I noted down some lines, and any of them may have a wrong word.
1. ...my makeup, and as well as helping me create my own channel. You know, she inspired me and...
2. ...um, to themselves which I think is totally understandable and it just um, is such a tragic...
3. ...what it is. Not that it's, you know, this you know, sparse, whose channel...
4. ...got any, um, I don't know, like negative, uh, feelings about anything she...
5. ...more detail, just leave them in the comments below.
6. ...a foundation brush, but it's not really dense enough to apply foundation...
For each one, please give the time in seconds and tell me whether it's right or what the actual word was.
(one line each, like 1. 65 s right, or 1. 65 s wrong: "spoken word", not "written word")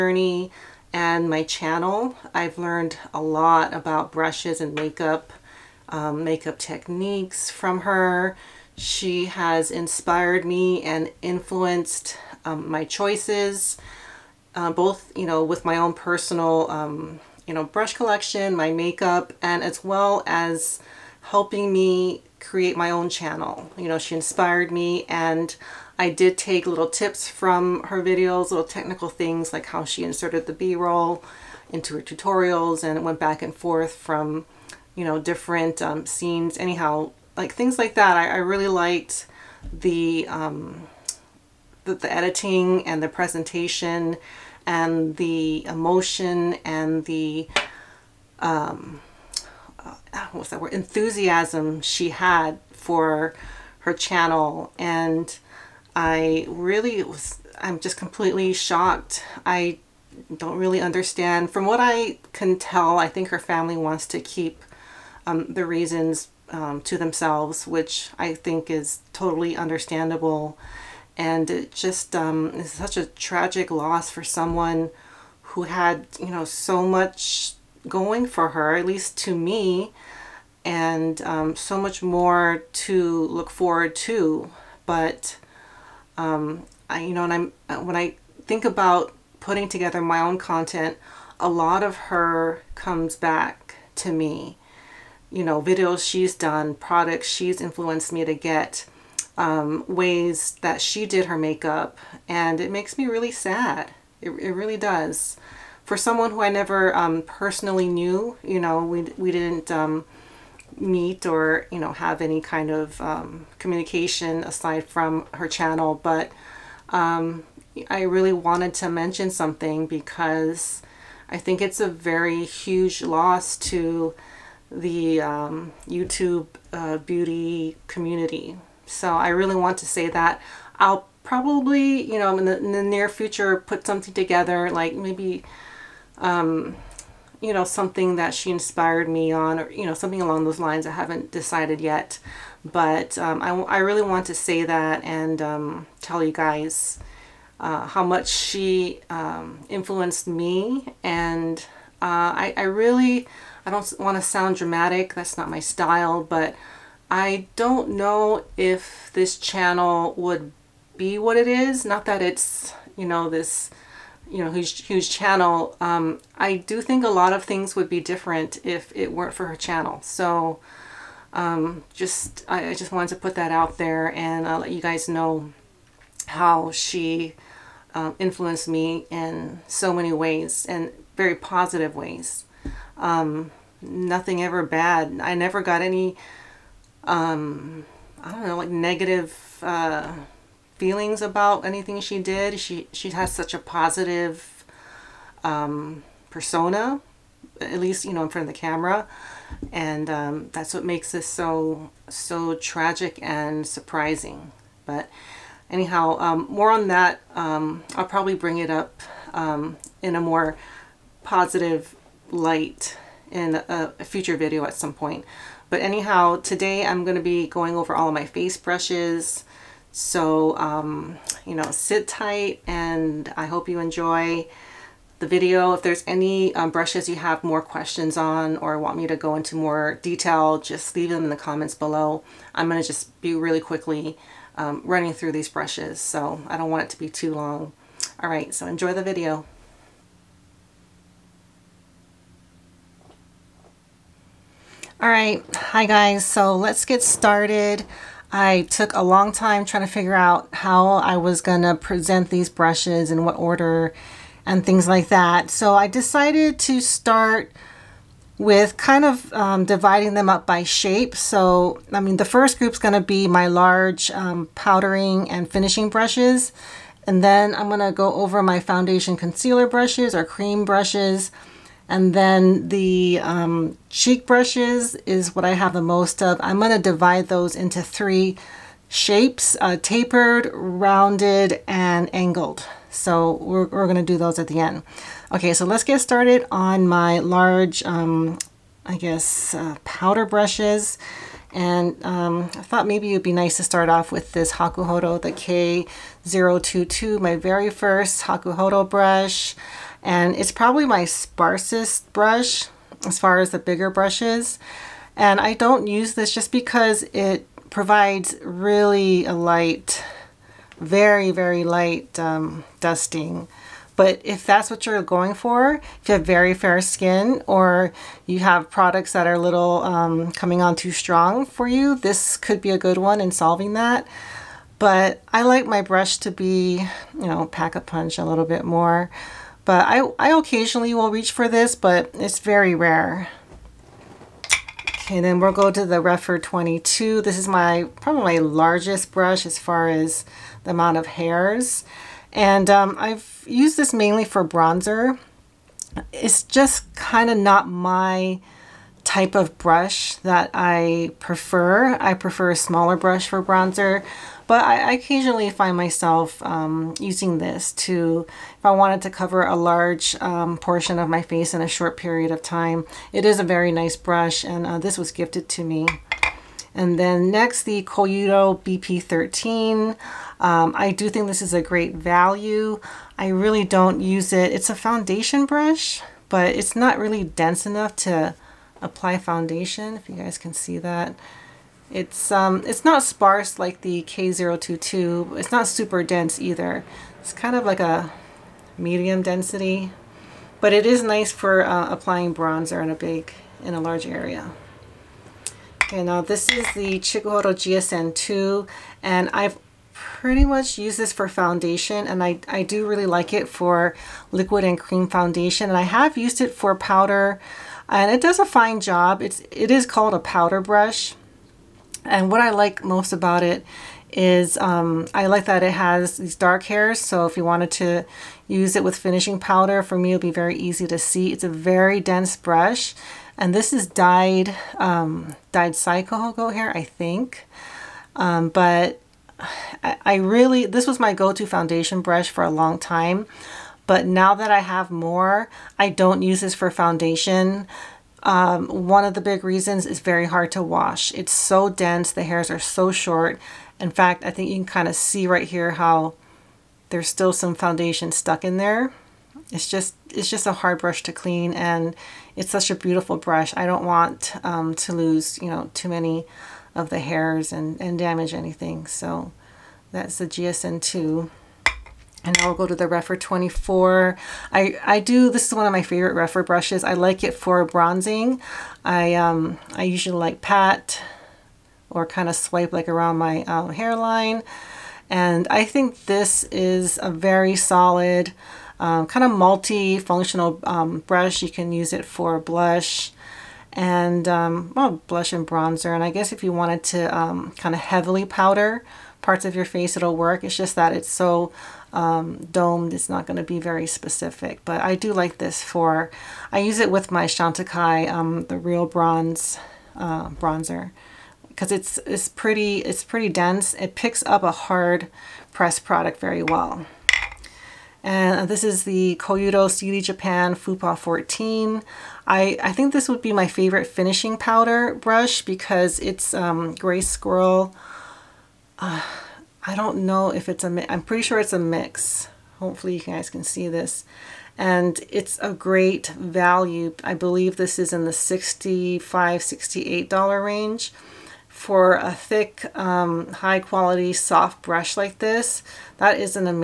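1. 18 s right
2. 66 s right
3. 161 s wrong: "whose", not "sparse"
4. 185 s right
5. 229 s right
6. 374 s right.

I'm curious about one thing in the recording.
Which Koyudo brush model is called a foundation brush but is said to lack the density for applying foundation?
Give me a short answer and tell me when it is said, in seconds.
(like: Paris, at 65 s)
BP13, at 368 s.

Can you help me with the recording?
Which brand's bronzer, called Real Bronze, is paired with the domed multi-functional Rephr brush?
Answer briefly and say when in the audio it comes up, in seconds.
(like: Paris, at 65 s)
Chantecaille, at 497 s.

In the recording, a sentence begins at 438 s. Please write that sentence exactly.
Um, one of the big reasons is very hard to wash.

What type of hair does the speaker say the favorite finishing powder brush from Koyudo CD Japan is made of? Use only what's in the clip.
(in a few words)
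Gray squirrel.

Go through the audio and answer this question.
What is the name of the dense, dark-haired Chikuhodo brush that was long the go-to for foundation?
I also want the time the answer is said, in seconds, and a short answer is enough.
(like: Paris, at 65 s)
GSN2, at 397 s.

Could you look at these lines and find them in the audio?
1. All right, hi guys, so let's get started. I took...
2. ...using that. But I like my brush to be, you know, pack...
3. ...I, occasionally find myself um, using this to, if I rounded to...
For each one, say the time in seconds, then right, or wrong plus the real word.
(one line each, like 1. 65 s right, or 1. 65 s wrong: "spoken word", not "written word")
1. 245 s right
2. 323 s wrong: "solving", not "using"
3. 354 s wrong: "wanted", not "rounded".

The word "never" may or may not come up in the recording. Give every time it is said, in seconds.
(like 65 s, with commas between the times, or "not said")
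106 s, 185 s.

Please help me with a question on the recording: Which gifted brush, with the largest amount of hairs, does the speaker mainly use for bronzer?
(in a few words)
Rephr 22.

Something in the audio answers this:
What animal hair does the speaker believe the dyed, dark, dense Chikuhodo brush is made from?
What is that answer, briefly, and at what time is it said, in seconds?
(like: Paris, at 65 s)
Cycle hair, at 425 s.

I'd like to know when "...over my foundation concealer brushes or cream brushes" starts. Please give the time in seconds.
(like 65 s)
268 s.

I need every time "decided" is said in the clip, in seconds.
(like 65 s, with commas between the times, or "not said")
141 s, 255 s.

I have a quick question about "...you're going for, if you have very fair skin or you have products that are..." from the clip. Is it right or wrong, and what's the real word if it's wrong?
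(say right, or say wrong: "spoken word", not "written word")
right.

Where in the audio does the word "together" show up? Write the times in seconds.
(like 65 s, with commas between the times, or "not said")
89 s, 134 s.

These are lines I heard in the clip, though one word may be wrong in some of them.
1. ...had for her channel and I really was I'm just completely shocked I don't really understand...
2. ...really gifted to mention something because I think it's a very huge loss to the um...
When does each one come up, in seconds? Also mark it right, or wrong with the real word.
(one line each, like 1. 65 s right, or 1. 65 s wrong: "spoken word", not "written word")
1. 52 s right
2. 118 s wrong: "wanted", not "gifted".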